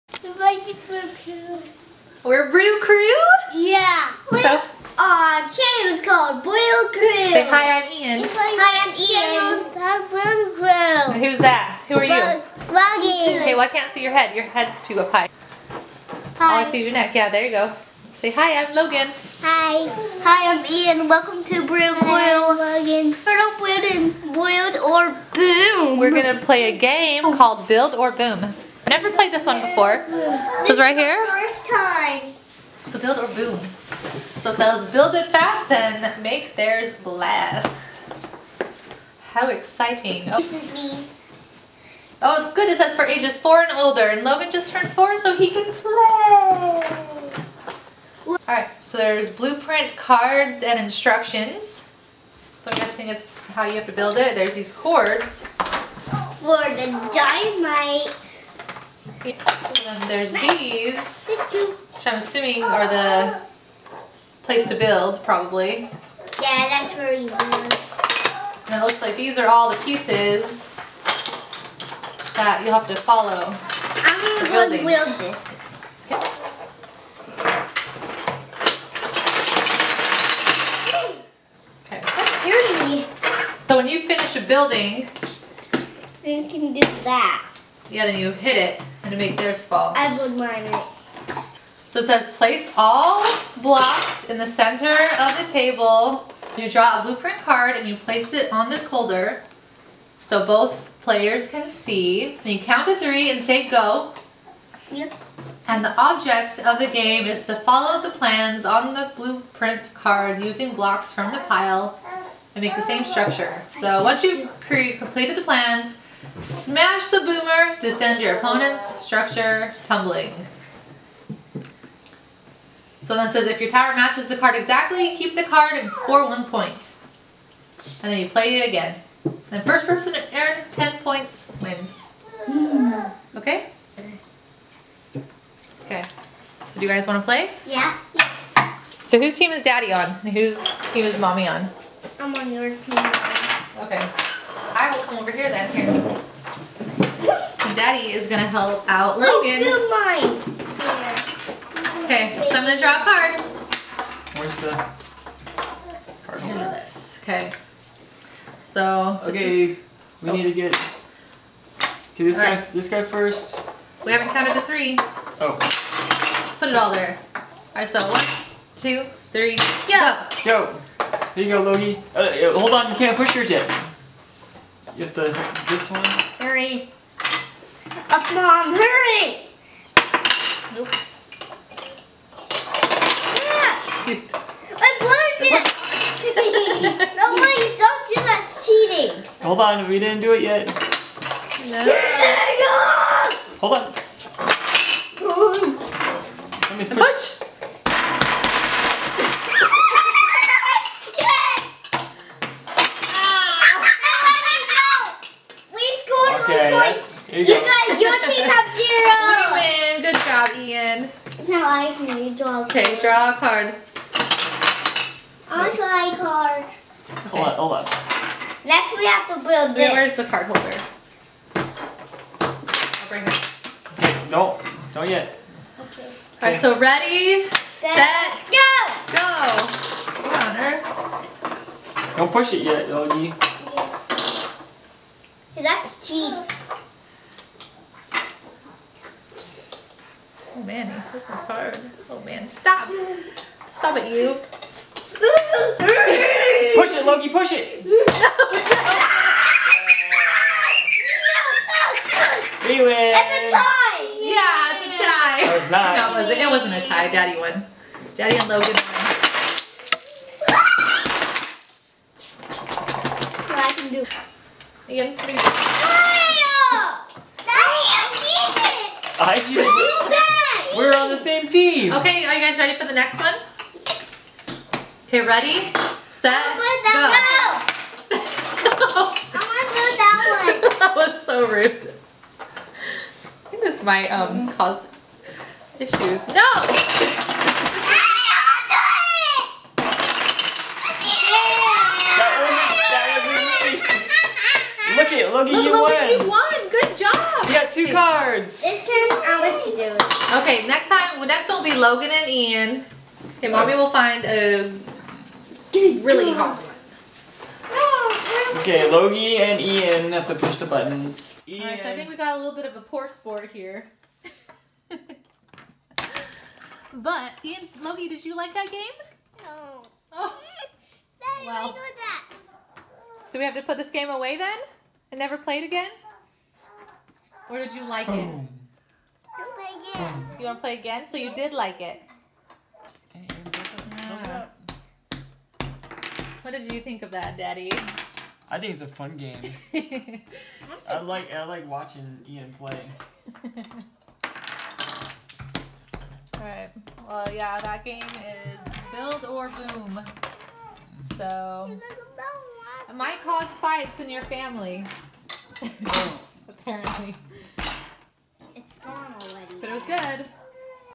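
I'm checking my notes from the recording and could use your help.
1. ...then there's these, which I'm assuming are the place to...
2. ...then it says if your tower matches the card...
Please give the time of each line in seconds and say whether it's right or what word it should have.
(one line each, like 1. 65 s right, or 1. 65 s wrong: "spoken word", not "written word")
1. 59 s right
2. 123 s right.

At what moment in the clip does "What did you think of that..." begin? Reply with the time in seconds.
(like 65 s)
336 s.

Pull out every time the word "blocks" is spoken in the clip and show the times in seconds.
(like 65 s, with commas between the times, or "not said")
93 s, 110 s.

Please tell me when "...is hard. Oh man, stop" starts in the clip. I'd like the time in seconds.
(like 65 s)
241 s.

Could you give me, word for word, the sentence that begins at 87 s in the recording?
Yeah, then you hit it to make theirs fall.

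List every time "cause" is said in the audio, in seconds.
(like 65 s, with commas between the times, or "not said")
284 s, 353 s.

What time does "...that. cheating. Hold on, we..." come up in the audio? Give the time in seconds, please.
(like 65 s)
188 s.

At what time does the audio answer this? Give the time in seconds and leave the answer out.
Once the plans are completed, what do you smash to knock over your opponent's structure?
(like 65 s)
117 s.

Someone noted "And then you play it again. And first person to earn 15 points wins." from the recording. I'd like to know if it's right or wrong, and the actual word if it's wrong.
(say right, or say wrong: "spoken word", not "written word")
wrong: "10", not "15".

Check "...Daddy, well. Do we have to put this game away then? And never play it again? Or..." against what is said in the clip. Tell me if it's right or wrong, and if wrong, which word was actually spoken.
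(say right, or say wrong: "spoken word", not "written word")
right.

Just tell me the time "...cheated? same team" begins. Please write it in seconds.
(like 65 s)
269 s.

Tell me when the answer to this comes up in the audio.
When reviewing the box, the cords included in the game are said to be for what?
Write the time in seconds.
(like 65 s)
56 s.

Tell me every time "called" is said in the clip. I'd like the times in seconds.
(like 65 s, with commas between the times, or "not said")
6 s, 27 s.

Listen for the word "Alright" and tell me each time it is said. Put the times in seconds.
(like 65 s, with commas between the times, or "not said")
311 s, 346 s.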